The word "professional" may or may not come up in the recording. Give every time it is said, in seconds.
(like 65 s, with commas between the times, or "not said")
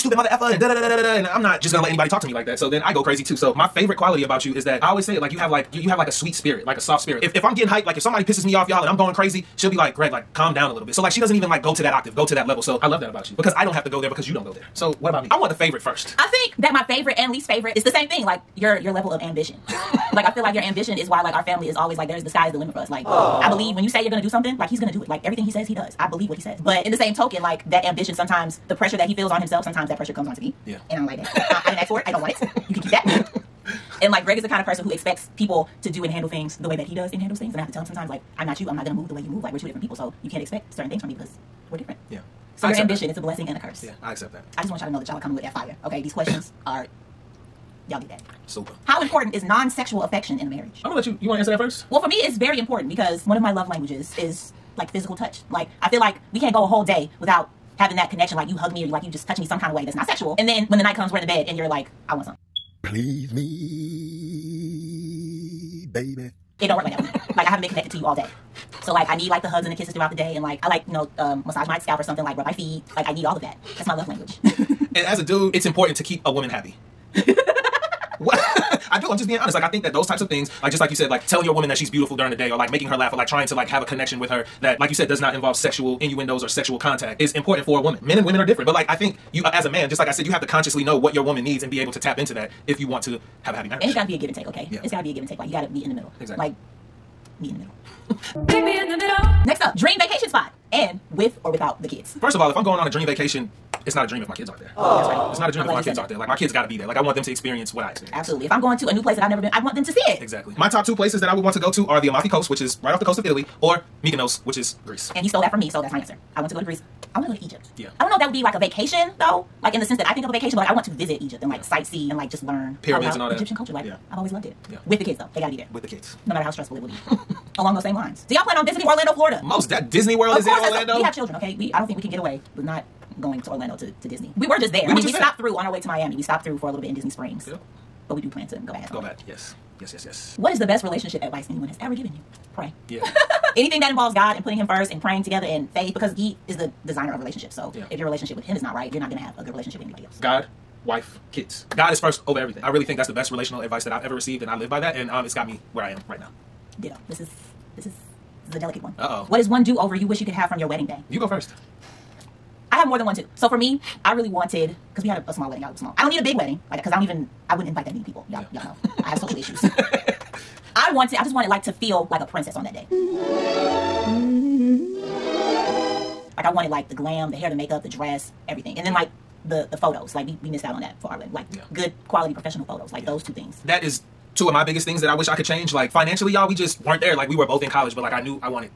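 182 s.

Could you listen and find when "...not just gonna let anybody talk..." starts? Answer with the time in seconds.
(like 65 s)
1 s.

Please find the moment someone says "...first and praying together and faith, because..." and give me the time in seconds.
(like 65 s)
144 s.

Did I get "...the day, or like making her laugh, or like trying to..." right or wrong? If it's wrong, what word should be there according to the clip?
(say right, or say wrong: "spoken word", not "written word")
right.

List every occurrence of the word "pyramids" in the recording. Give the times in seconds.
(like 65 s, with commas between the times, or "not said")
122 s.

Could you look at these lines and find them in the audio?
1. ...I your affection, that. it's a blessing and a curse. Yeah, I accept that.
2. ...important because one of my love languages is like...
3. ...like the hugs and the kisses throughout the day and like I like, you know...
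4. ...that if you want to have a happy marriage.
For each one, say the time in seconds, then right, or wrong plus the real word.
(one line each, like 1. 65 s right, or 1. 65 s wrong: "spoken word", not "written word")
1. 42 s wrong: "ambition", not "affection"
2. 52 s right
3. 69 s right
4. 92 s right.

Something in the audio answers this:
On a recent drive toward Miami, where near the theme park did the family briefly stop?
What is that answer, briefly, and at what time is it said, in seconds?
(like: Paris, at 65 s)
Disney Springs, at 136 s.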